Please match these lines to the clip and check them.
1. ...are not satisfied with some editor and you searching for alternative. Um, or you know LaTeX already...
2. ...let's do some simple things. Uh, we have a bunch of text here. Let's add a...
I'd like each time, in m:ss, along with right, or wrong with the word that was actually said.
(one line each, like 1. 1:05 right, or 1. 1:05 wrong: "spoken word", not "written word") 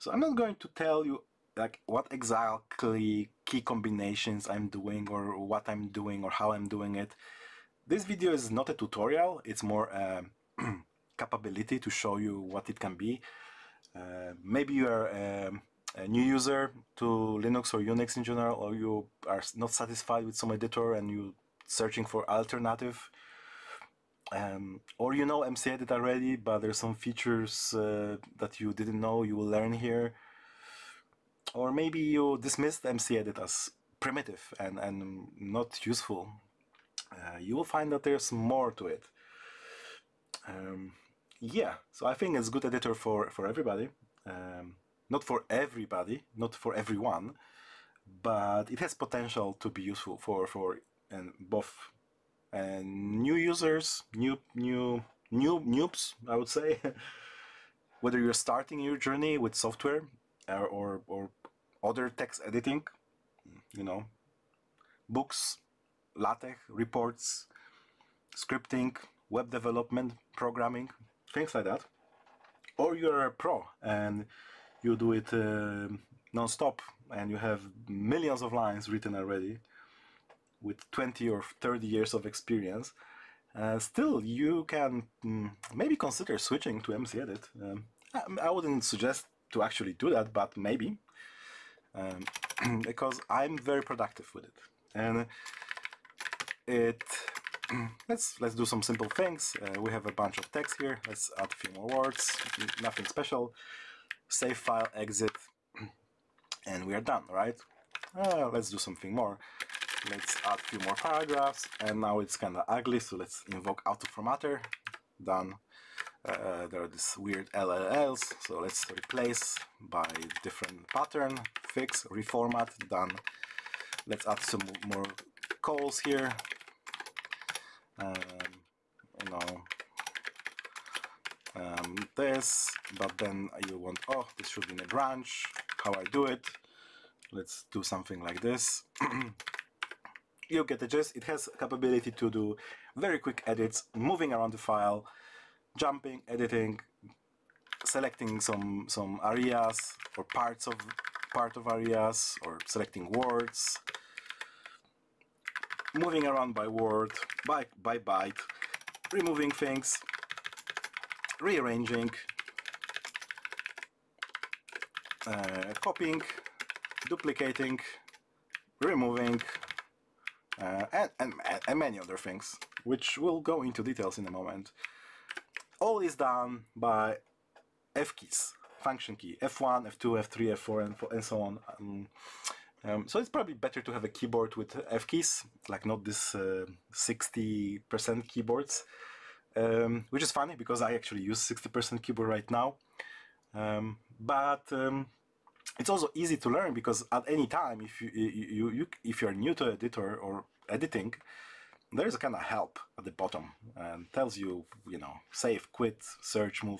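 1. 0:19 wrong: "MCEdit", not "LaTeX"
2. 1:38 right.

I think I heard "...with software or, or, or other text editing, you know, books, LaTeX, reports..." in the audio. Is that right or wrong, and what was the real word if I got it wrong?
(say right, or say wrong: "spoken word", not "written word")
right.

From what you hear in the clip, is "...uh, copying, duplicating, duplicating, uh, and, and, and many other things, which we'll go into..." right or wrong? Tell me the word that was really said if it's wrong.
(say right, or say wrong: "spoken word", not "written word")
wrong: "removing", not "duplicating".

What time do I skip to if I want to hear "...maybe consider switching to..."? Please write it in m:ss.
1:25.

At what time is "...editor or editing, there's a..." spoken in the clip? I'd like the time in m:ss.
3:19.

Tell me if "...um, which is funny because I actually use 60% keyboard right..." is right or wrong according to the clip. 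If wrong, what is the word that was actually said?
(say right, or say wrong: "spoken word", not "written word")
right.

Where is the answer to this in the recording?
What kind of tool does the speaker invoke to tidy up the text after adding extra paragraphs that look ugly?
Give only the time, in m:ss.
1:53.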